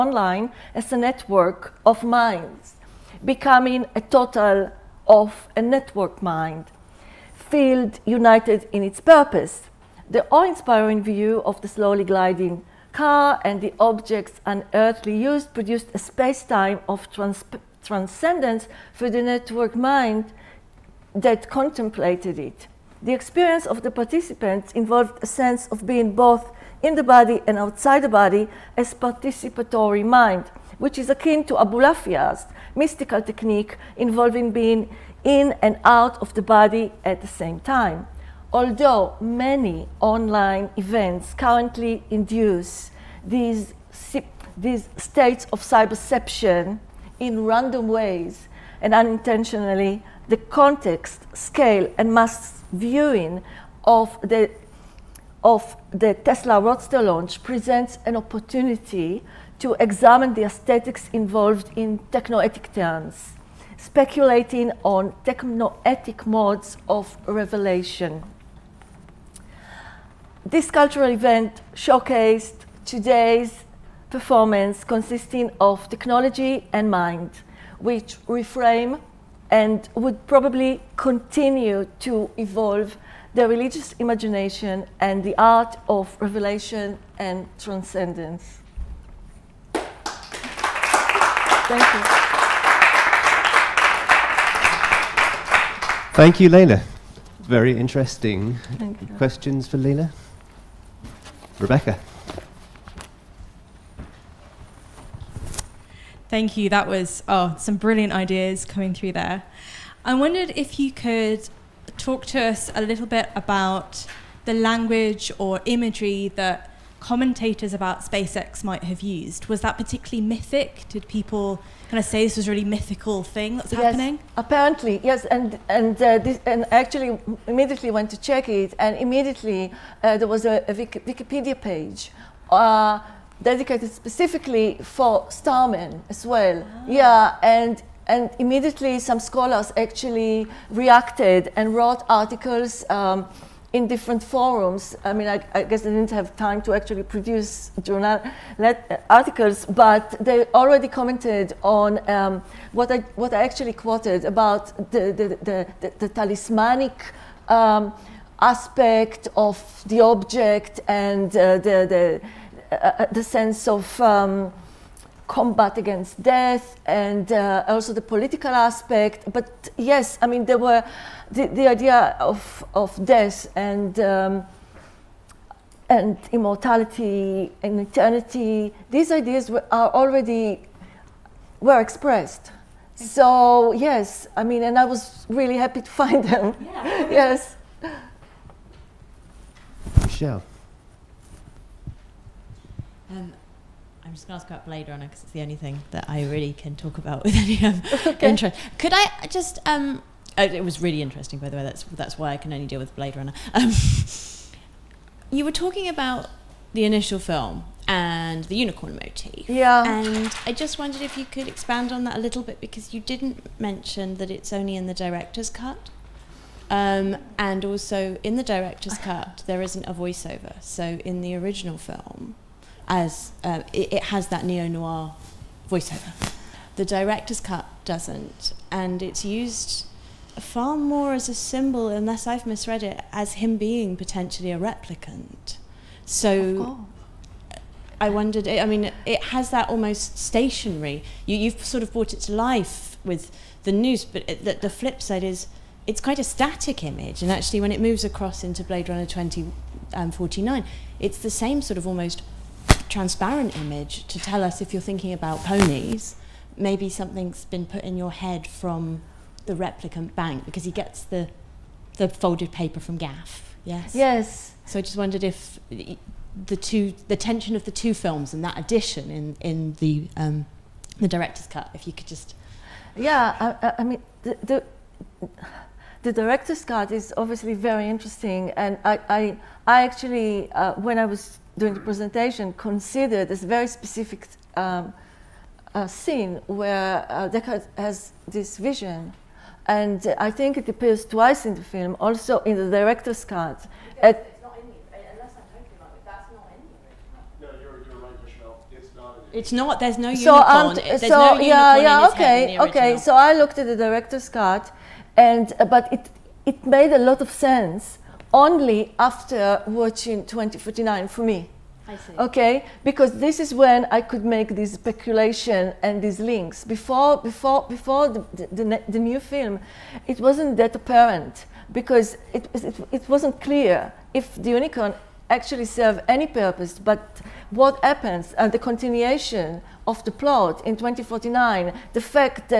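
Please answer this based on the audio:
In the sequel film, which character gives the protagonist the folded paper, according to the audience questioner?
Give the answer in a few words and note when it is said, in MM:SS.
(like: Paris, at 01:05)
Gaff, at 04:22.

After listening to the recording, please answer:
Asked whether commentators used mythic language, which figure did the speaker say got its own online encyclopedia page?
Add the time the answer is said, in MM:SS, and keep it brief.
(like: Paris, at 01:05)
Starman, at 02:15.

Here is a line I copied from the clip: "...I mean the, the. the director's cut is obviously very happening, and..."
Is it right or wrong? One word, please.
wrong.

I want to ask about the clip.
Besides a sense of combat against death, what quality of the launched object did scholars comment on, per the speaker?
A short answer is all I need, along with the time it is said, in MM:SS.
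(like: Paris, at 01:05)
talismanic, at 02:36.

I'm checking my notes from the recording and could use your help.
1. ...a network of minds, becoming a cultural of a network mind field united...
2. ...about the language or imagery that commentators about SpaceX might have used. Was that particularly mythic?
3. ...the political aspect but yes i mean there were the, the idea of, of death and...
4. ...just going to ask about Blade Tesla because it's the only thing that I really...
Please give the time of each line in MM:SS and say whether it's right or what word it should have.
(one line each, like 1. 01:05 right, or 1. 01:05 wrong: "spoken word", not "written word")
1. 00:00 wrong: "total", not "cultural"
2. 01:53 right
3. 02:47 right
4. 03:14 wrong: "Runner", not "Tesla".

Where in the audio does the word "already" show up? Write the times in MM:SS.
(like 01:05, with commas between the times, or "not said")
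02:30, 02:59.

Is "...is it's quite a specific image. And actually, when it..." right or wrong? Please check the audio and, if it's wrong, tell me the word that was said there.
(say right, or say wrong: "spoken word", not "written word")
wrong: "static", not "specific".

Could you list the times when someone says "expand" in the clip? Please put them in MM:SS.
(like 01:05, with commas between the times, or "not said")
03:31.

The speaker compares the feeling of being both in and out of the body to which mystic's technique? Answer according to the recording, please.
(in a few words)
Abulafia.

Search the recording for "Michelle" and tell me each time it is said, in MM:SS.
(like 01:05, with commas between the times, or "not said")
03:10, 04:58.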